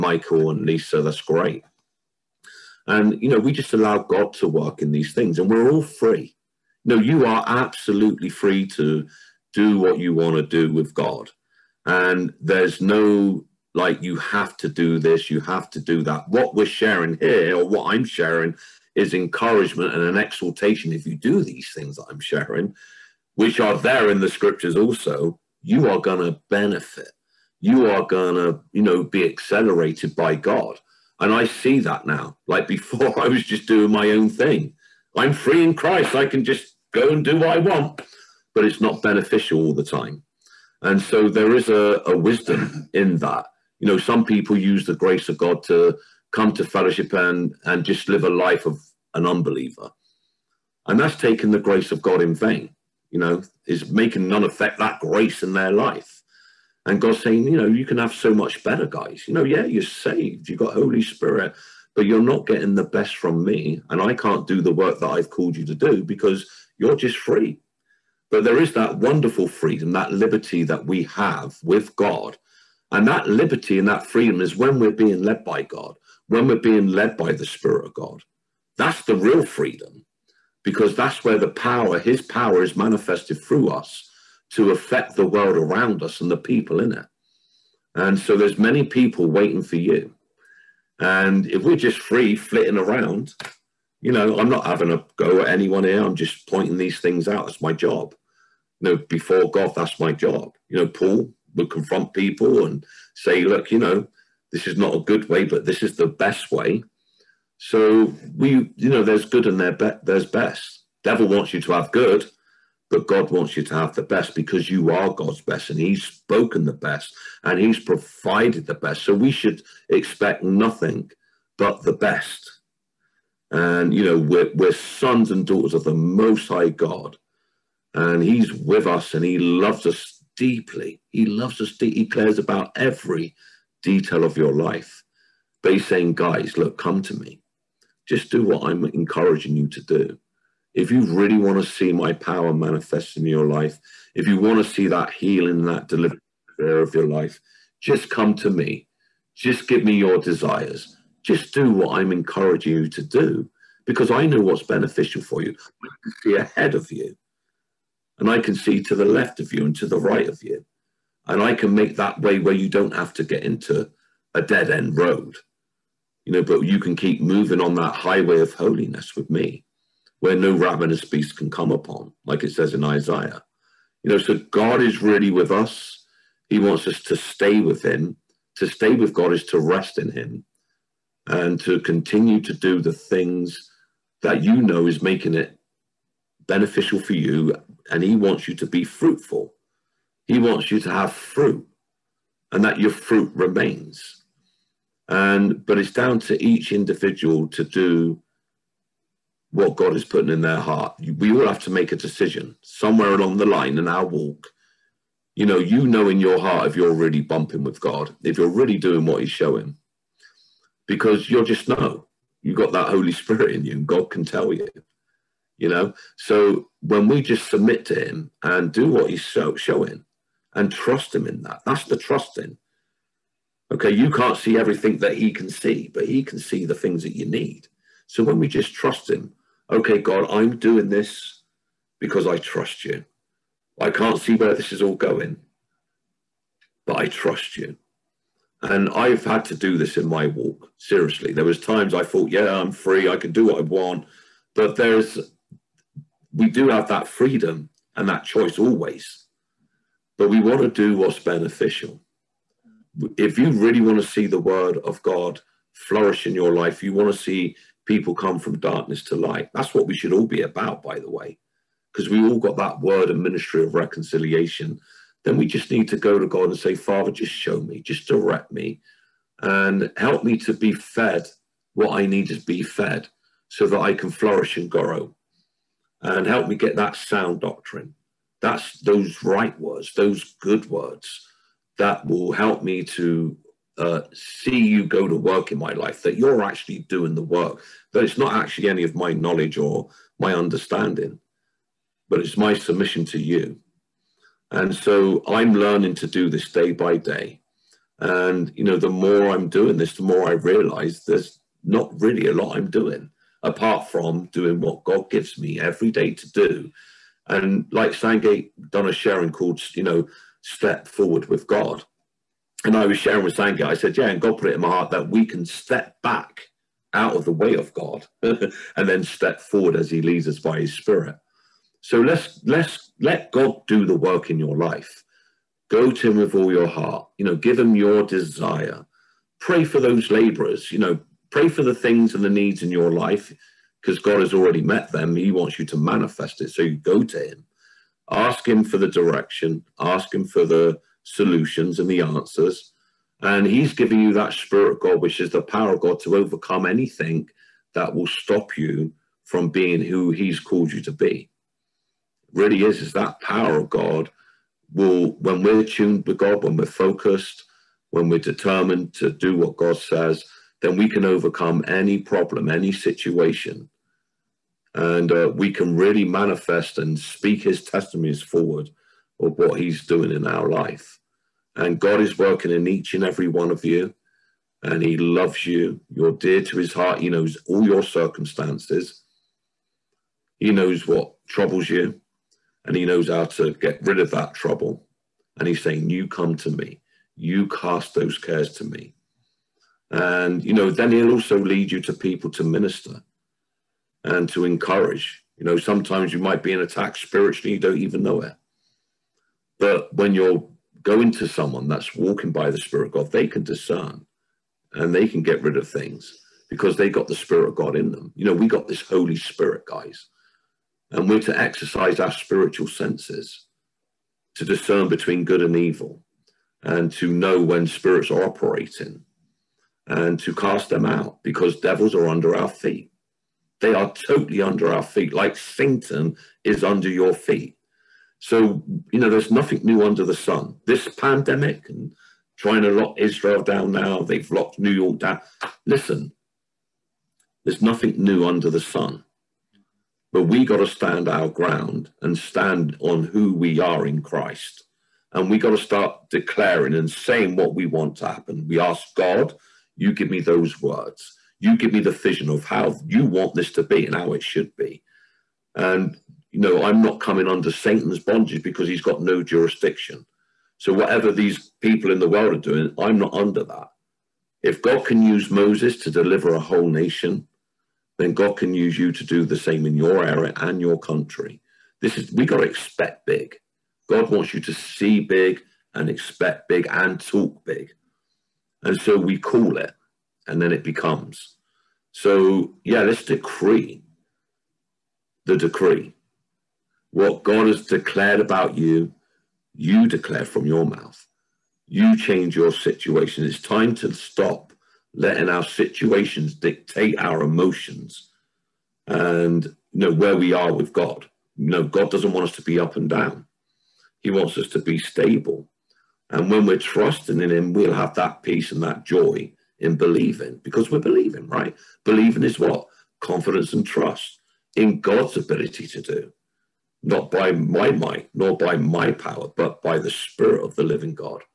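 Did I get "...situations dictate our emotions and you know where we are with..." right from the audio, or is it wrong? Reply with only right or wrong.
right.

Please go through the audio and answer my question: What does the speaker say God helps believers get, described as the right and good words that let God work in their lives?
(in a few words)
sound doctrine.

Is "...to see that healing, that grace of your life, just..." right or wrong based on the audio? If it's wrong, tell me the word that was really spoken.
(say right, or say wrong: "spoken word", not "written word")
wrong: "deliverance", not "grace".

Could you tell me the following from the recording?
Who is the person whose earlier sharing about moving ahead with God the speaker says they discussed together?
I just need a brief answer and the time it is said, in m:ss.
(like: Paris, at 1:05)
Sangate, at 5:07.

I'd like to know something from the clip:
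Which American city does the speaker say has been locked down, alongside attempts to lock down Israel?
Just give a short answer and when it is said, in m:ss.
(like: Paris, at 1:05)
New York, at 7:14.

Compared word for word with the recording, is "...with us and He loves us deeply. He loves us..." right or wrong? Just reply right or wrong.
right.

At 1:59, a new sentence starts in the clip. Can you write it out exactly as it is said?
So we should expect nothing but the best.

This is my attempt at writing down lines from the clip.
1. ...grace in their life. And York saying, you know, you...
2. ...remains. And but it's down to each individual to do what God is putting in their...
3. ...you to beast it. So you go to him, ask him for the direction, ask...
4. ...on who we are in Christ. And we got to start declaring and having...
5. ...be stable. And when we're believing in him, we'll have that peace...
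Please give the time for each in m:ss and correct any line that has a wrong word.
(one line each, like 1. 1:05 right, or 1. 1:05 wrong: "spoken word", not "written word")
1. 0:54 wrong: "God", not "York"
2. 3:13 right
3. 5:35 wrong: "manifest", not "beast"
4. 7:22 wrong: "saying", not "having"
5. 8:24 wrong: "trusting", not "believing".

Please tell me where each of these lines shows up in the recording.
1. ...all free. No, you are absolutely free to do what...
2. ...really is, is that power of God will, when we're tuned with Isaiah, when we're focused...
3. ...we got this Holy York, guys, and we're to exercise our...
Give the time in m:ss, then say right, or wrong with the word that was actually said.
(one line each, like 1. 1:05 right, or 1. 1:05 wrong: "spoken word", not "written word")
1. 0:05 right
2. 5:52 wrong: "God", not "Isaiah"
3. 6:48 wrong: "Spirit", not "York".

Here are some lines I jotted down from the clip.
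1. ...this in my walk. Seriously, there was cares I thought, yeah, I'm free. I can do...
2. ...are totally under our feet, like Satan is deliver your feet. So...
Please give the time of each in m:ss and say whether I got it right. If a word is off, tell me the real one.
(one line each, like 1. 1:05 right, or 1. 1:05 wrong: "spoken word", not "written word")
1. 3:59 wrong: "times", not "cares"
2. 7:03 wrong: "under", not "deliver".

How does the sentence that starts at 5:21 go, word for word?
So let's, let's let God do the work in your life.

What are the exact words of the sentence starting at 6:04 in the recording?
And uh, we can really manifest and speak his testimonies forward of what he's doing in our life.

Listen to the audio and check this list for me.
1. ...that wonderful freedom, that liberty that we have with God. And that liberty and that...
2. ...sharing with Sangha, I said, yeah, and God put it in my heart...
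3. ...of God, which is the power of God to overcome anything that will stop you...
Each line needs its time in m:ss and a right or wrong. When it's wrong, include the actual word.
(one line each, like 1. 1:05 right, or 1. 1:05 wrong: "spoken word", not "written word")
1. 1:08 right
2. 5:12 right
3. 5:44 right.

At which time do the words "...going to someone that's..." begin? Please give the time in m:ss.
6:40.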